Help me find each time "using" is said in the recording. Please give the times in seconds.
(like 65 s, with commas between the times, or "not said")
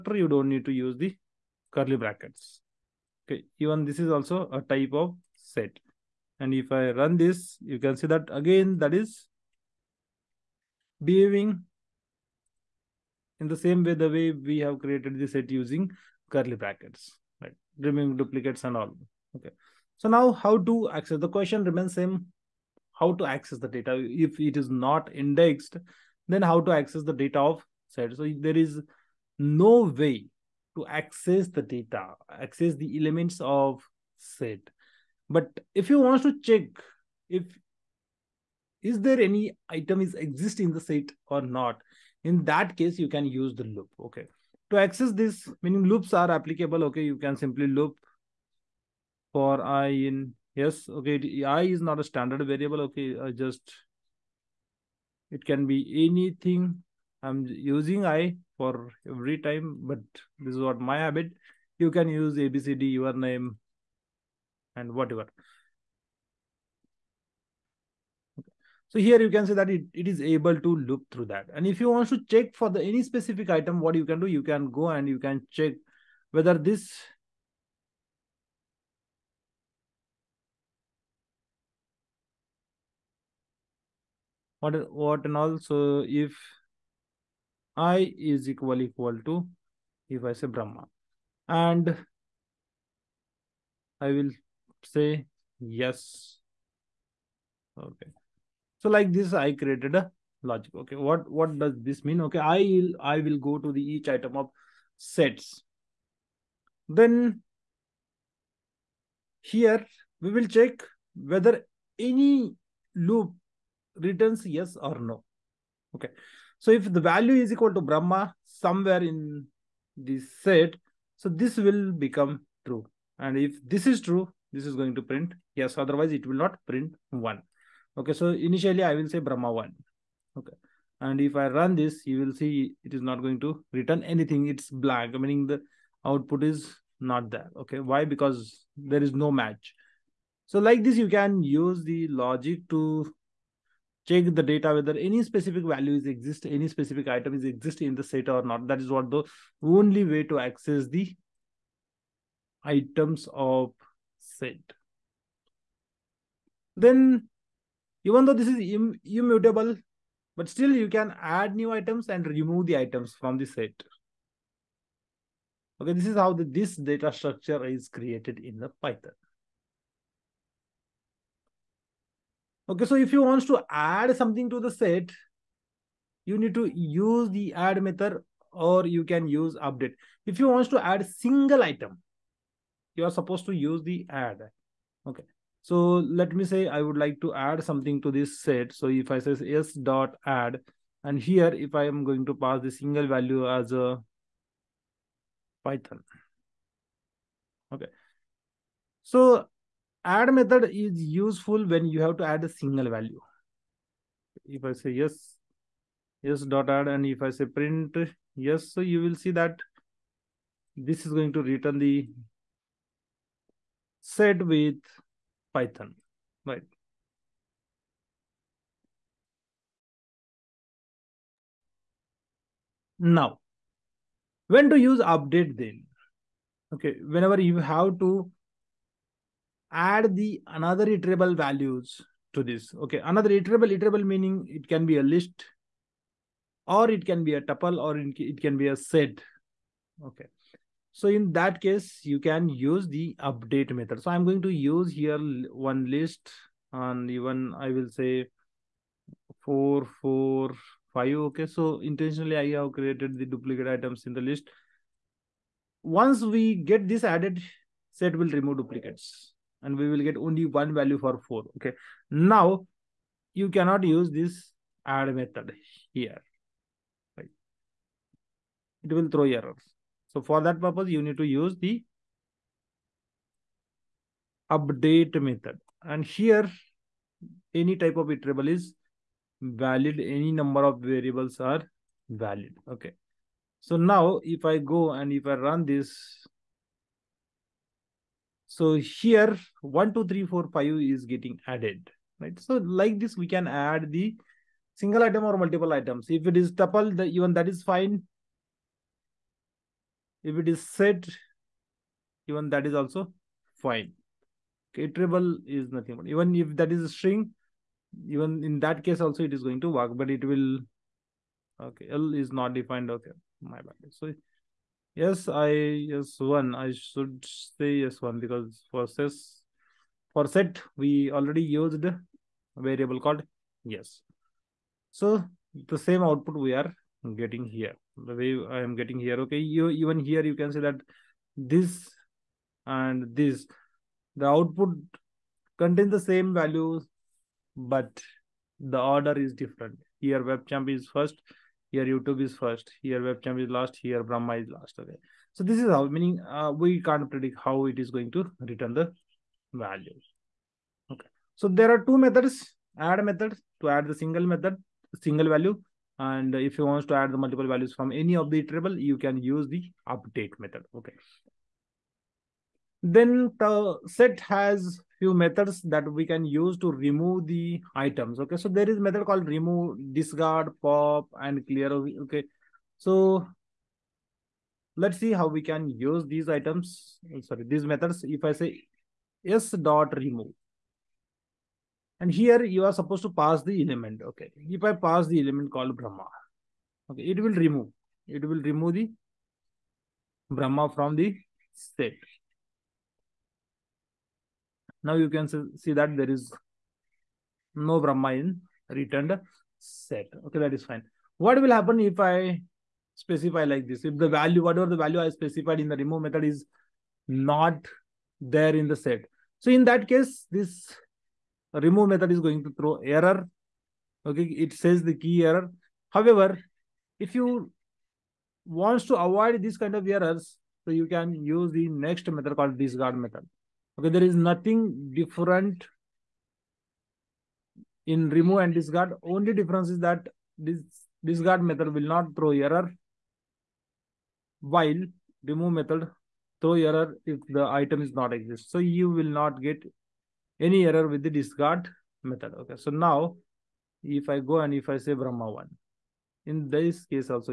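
15 s, 57 s.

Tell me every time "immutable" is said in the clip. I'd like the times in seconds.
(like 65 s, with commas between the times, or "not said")
159 s.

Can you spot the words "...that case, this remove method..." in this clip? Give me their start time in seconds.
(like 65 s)
409 s.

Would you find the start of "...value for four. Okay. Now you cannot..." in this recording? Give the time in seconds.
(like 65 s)
260 s.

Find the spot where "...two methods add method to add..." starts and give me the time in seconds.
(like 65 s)
351 s.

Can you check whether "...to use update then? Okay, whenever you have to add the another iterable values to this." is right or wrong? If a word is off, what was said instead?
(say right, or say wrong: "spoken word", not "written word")
right.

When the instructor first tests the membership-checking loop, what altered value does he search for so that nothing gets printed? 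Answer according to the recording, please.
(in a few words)
Brahma1.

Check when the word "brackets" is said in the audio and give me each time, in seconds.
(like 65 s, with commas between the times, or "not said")
1 s, 16 s.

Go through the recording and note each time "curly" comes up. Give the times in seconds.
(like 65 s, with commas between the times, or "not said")
1 s, 16 s.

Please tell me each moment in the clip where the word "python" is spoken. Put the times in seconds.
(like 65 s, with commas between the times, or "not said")
168 s, 195 s, 215 s.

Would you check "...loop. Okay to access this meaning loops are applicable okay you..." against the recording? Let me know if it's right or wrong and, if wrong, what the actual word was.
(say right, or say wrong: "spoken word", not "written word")
right.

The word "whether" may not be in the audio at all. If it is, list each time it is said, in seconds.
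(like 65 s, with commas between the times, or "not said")
76 s, 111 s, 144 s.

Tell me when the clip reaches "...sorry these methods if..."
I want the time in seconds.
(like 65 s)
377 s.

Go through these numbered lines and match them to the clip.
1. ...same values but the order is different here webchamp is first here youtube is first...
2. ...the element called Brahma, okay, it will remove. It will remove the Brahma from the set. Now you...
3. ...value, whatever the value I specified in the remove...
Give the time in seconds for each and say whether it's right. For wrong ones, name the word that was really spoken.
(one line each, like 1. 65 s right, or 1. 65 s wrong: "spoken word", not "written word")
1. 336 s right
2. 385 s right
3. 404 s right.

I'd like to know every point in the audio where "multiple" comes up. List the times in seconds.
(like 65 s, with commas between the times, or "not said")
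295 s, 357 s.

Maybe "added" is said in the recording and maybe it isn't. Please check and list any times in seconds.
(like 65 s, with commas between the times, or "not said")
257 s, 291 s.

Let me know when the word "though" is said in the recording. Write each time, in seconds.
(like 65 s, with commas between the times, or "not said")
158 s.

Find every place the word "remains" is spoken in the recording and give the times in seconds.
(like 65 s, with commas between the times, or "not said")
21 s.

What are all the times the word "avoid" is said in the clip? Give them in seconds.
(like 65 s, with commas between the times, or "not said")
418 s.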